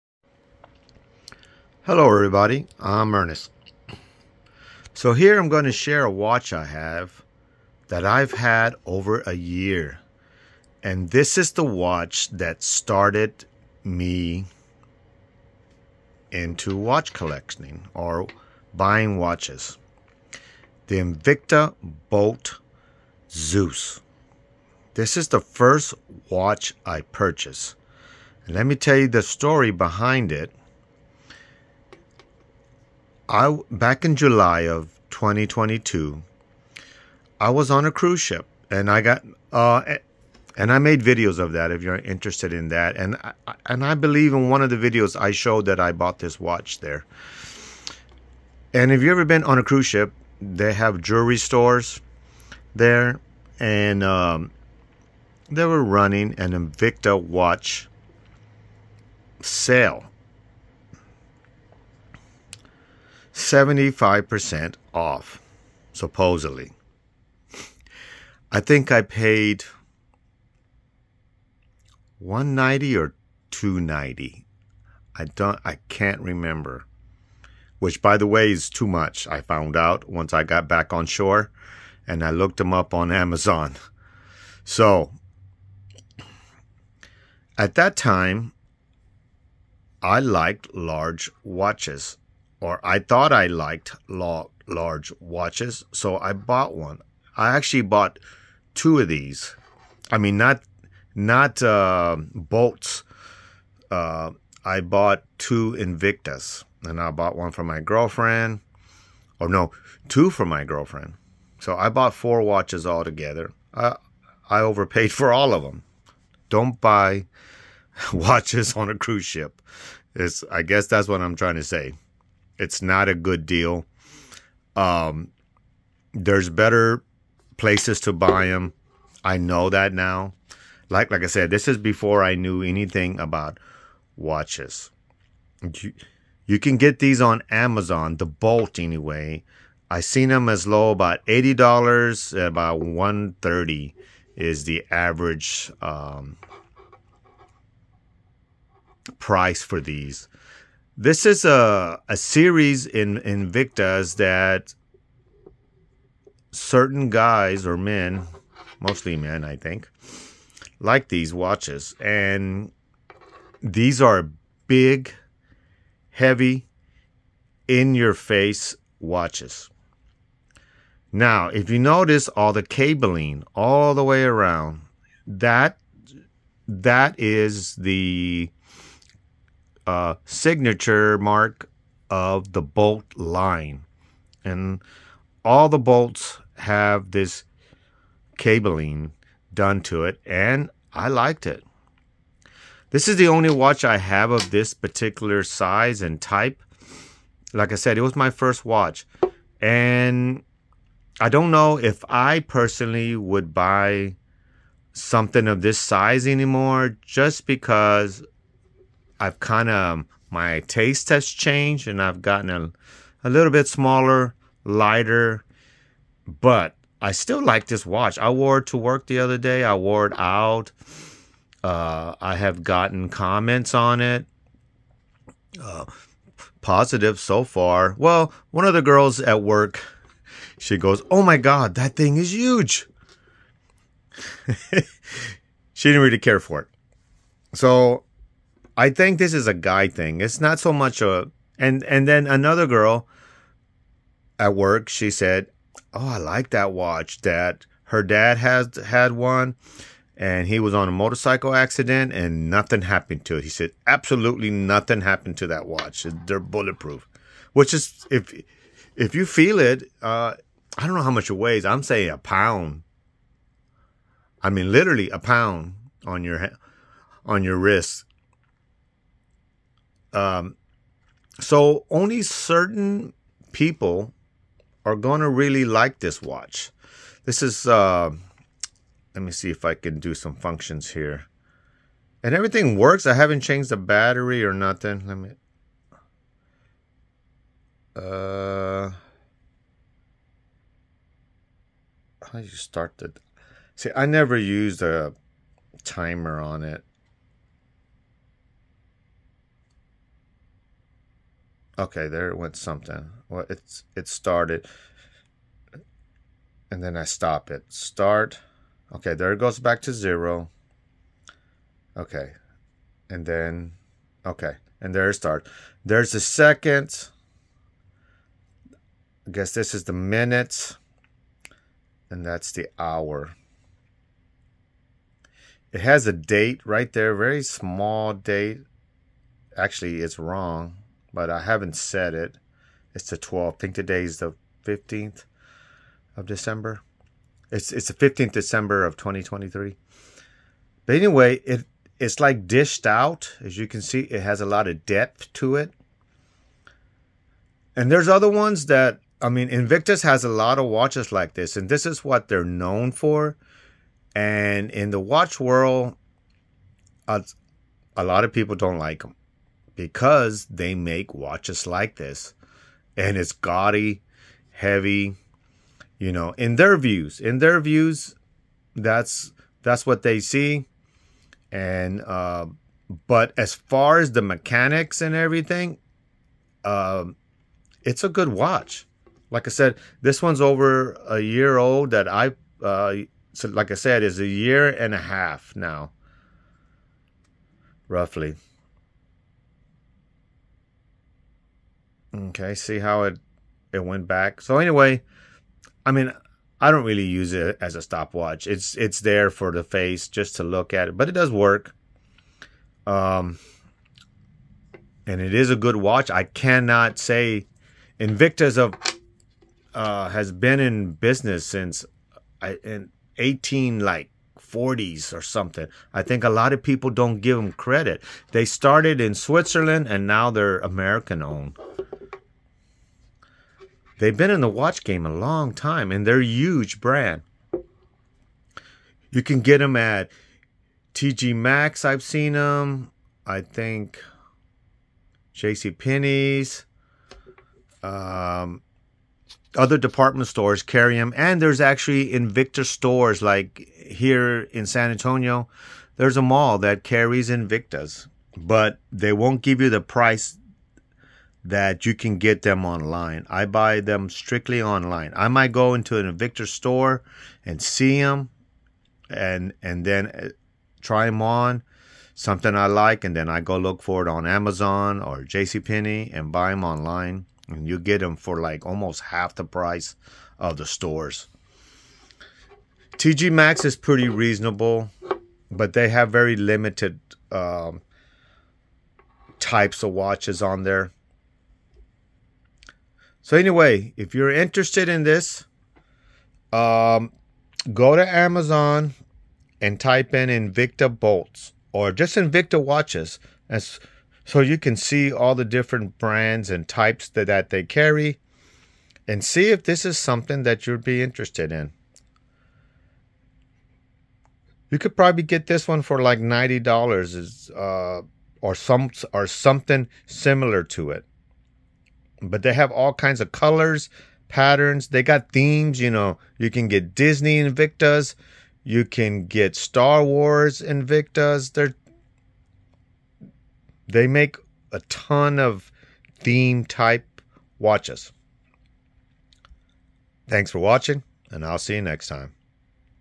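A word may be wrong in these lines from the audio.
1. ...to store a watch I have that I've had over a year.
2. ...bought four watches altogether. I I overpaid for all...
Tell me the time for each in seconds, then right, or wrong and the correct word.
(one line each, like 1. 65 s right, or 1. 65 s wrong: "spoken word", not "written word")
1. 5 s wrong: "share", not "store"
2. 111 s right.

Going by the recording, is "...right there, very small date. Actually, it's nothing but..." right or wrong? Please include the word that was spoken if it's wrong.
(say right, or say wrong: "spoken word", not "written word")
wrong: "wrong", not "nothing".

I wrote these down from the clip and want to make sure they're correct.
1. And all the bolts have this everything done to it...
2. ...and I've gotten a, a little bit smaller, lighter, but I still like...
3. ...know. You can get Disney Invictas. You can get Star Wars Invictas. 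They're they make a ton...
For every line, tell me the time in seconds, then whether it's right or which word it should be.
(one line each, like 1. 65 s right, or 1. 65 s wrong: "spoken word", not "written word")
1. 184 s wrong: "cabling", not "everything"
2. 211 s right
3. 515 s right.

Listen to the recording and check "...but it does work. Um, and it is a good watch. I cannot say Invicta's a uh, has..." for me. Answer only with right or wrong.
right.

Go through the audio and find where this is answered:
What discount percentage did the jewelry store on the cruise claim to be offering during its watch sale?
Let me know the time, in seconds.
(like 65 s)
63 s.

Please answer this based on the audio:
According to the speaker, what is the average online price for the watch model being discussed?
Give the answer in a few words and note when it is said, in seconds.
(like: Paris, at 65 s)
$130, at 142 s.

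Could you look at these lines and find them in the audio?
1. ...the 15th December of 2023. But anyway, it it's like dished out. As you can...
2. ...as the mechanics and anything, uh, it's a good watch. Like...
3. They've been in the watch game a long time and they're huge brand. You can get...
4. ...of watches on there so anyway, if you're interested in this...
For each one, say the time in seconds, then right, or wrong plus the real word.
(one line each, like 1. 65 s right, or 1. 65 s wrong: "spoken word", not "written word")
1. 337 s right
2. 373 s wrong: "everything", not "anything"
3. 424 s right
4. 479 s right.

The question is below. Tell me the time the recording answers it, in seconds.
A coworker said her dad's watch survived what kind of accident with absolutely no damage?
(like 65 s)
250 s.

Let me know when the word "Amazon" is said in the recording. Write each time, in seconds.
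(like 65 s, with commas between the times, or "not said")
83 s, 137 s, 464 s, 488 s.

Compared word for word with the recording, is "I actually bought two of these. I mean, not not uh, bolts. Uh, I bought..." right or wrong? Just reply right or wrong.
right.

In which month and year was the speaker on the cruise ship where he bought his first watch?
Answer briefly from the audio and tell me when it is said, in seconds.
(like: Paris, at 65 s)
July 2022, at 34 s.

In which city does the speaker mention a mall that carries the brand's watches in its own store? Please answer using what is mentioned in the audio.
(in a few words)
San Antonio.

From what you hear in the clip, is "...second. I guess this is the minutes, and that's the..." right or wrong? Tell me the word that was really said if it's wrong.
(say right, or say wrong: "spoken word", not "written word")
right.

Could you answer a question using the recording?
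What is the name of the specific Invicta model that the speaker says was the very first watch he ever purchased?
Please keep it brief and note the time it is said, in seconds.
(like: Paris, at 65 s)
Bolt Zeus, at 22 s.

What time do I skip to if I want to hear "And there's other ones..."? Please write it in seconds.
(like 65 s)
347 s.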